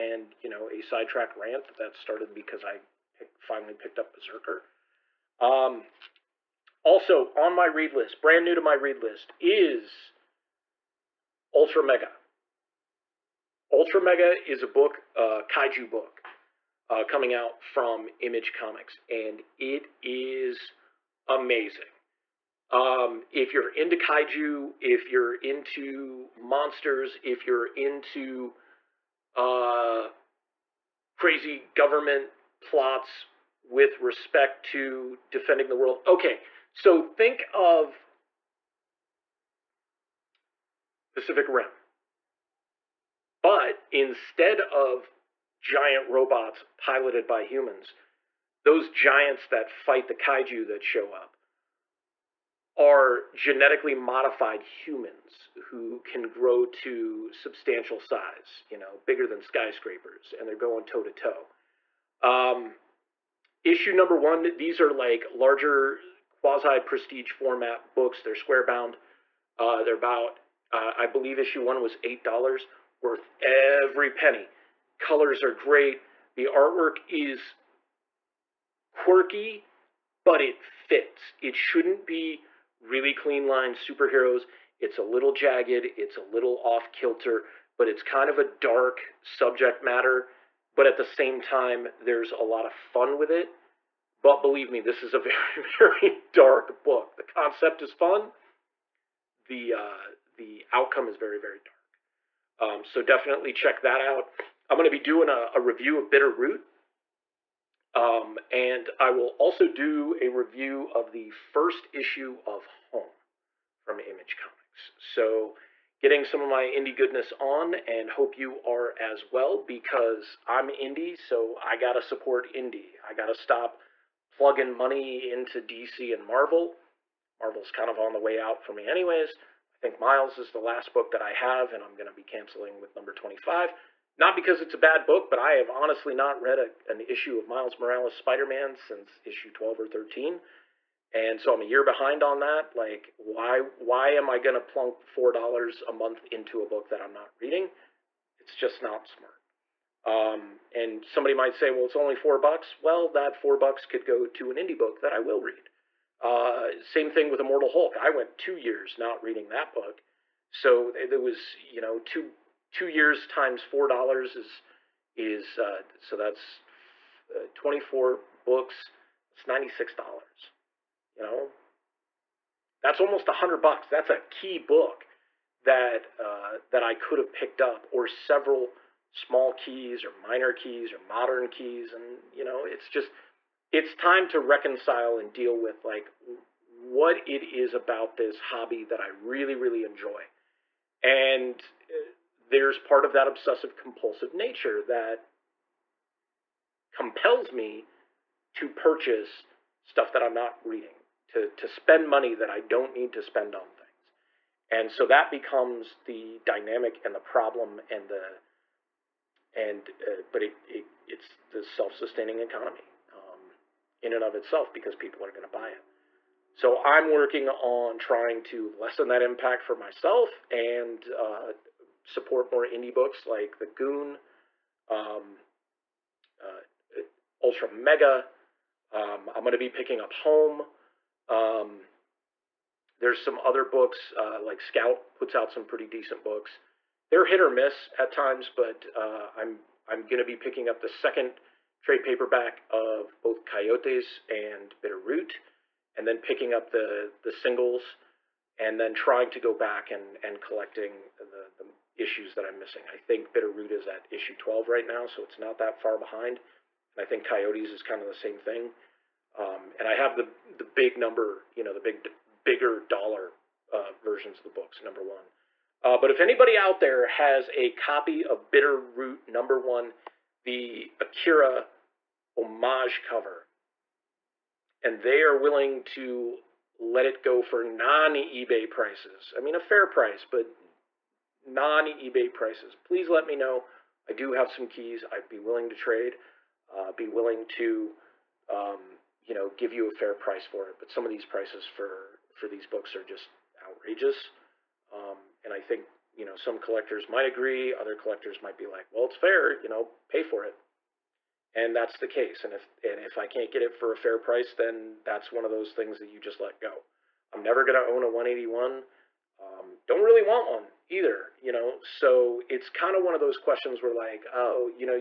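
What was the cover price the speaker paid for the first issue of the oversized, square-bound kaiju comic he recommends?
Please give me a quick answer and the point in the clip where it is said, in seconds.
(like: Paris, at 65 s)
$8, at 71 s.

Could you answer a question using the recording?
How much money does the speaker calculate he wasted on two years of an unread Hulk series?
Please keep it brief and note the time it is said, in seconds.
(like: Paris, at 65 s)
$96, at 169 s.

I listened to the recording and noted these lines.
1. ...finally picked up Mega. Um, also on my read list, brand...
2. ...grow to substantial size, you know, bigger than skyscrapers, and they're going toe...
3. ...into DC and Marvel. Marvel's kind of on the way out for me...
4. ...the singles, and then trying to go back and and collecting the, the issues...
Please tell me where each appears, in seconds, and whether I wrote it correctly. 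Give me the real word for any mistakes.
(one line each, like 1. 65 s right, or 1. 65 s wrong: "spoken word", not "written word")
1. 3 s wrong: "BRZRKR", not "Mega"
2. 56 s right
3. 125 s right
4. 247 s right.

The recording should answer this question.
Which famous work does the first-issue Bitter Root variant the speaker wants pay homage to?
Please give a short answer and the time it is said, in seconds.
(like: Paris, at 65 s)
Akira, at 270 s.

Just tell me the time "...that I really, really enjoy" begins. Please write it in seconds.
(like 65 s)
188 s.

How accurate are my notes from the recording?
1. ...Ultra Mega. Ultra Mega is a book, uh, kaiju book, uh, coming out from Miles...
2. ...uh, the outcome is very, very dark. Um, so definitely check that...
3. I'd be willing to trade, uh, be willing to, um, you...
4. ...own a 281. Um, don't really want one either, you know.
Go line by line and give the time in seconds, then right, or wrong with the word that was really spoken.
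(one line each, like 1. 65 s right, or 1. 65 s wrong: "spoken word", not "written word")
1. 11 s wrong: "Image", not "Miles"
2. 99 s right
3. 285 s right
4. 307 s wrong: "181", not "281".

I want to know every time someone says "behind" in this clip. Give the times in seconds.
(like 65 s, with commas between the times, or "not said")
141 s, 255 s.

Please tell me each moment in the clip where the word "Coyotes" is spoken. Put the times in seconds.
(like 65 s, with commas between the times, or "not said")
243 s, 257 s.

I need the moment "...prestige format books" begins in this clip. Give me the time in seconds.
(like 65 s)
66 s.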